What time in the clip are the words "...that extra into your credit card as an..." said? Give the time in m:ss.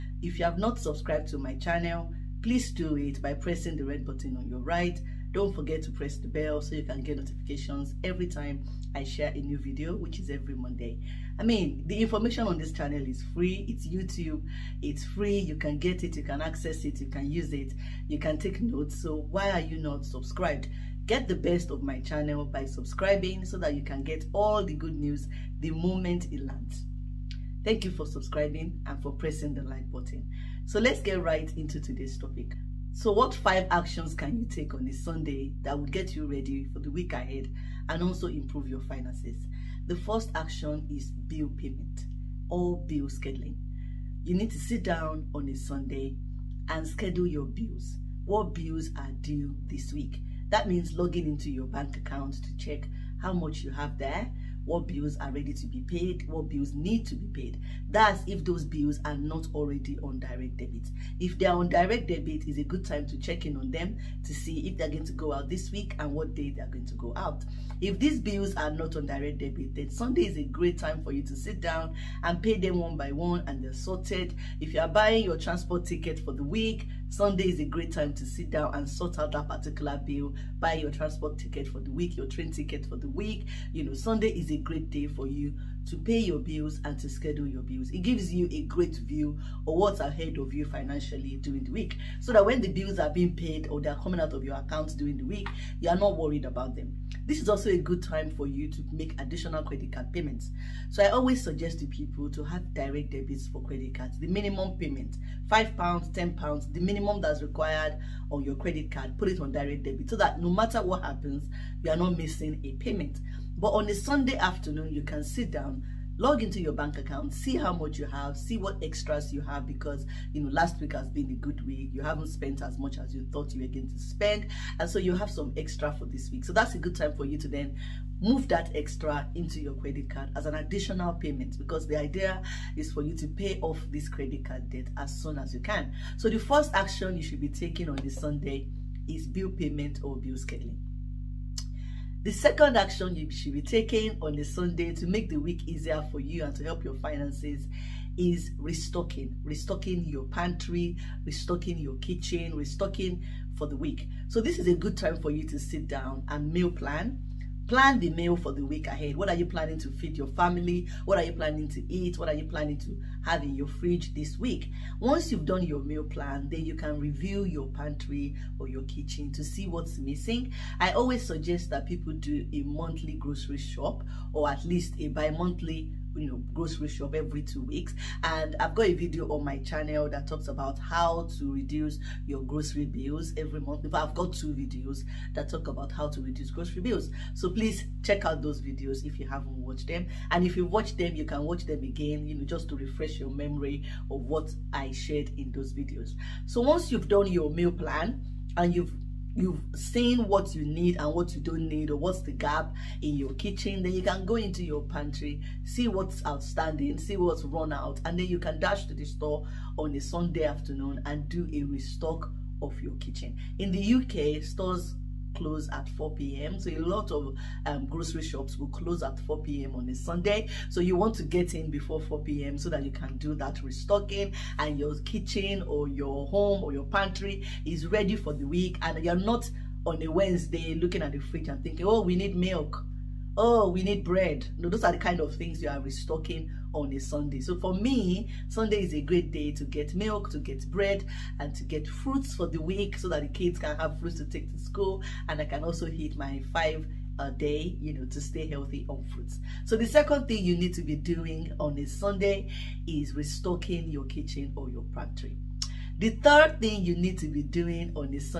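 2:08.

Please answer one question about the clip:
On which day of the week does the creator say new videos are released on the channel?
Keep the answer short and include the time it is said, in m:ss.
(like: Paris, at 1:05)
Monday, at 0:10.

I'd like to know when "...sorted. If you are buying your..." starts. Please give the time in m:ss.
1:13.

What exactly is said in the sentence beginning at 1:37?
This is also a good time for you to make additional credit card payments.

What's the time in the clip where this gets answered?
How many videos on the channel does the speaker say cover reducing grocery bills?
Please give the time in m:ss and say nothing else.
3:04.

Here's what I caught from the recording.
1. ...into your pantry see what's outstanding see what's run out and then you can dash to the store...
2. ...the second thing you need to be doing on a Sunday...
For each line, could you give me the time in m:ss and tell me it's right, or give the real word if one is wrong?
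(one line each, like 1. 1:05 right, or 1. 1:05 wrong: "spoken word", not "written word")
1. 3:24 right
2. 4:09 right.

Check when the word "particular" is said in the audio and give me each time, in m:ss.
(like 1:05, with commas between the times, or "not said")
1:19.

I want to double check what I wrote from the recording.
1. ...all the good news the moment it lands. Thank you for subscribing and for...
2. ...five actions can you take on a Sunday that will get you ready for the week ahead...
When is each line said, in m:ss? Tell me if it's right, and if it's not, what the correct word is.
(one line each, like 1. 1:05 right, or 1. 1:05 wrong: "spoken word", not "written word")
1. 0:24 right
2. 0:33 right.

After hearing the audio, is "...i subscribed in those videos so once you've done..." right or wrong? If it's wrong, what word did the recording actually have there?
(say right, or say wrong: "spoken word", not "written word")
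wrong: "shared", not "subscribed".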